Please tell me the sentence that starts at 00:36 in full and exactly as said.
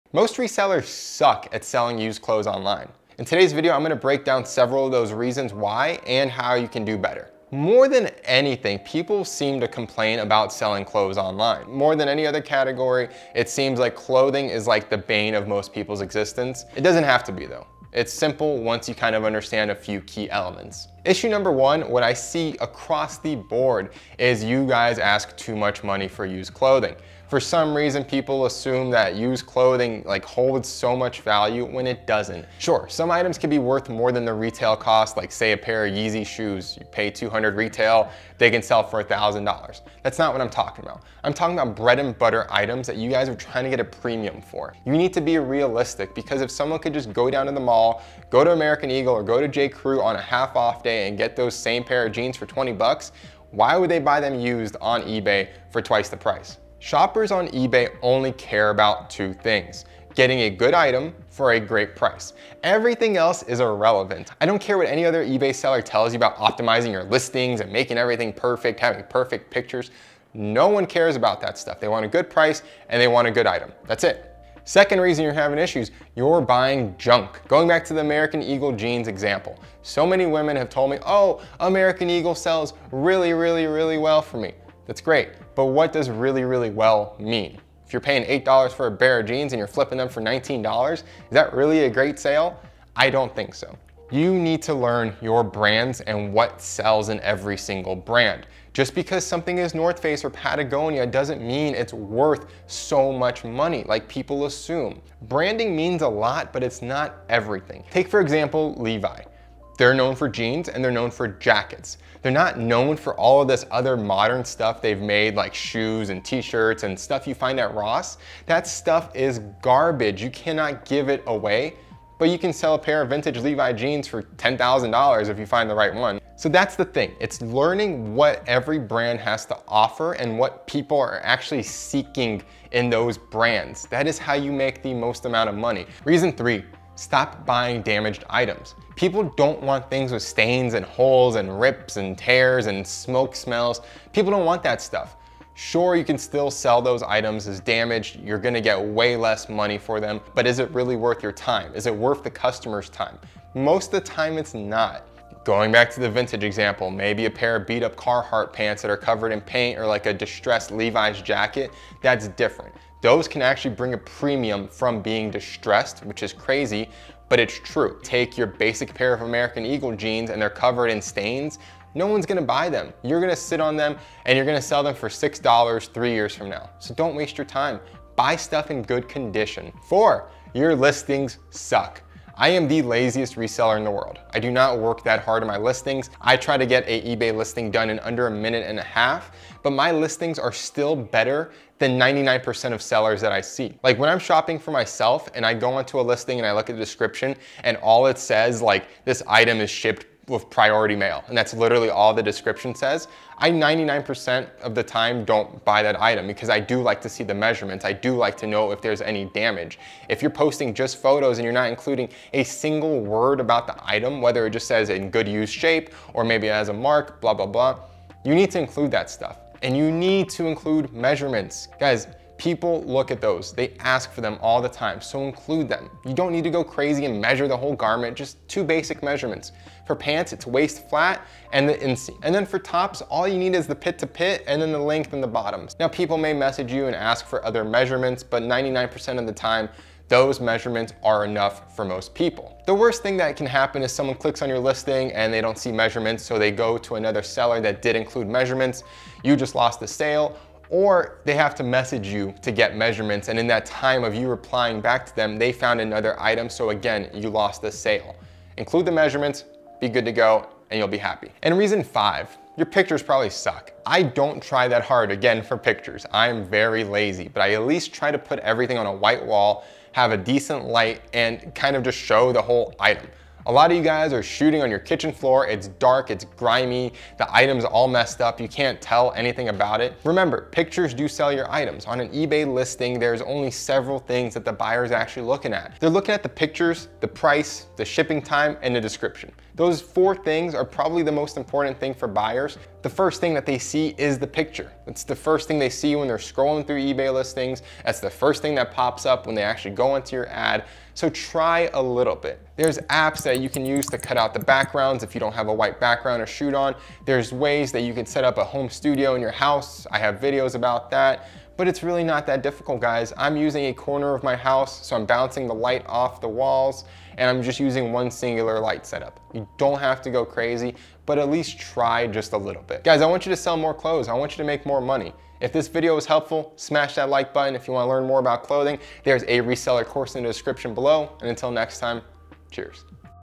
You pay 200 retail, they can sell for $1,000.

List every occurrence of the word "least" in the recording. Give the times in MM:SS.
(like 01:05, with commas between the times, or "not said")
04:27, 05:21.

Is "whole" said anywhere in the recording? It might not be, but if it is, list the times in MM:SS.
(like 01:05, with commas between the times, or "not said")
03:47, 04:32.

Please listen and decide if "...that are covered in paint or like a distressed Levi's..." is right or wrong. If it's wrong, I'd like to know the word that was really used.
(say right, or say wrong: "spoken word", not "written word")
right.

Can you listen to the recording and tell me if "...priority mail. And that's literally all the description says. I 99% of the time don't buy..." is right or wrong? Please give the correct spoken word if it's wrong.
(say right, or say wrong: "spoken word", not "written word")
right.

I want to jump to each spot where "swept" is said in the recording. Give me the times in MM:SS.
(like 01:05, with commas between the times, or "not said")
not said.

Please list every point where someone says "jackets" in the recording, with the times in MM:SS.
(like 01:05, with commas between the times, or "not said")
01:51, 02:41.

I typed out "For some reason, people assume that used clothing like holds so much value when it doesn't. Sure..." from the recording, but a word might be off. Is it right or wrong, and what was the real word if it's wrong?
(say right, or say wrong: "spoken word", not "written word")
right.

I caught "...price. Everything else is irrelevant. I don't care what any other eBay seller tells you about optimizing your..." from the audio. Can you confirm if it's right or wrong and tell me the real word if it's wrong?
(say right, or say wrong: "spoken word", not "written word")
right.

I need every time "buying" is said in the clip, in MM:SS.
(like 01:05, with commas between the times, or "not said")
01:16, 02:17.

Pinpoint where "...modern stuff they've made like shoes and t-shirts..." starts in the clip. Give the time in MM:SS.
01:53.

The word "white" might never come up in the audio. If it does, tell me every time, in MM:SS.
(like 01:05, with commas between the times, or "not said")
04:28, 05:05.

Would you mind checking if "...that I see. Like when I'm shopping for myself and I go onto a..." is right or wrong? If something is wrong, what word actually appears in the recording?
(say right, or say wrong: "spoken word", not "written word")
right.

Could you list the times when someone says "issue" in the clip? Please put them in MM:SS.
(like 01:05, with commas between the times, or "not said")
00:21, 01:15.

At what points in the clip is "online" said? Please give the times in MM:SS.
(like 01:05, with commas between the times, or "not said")
00:02, 00:11.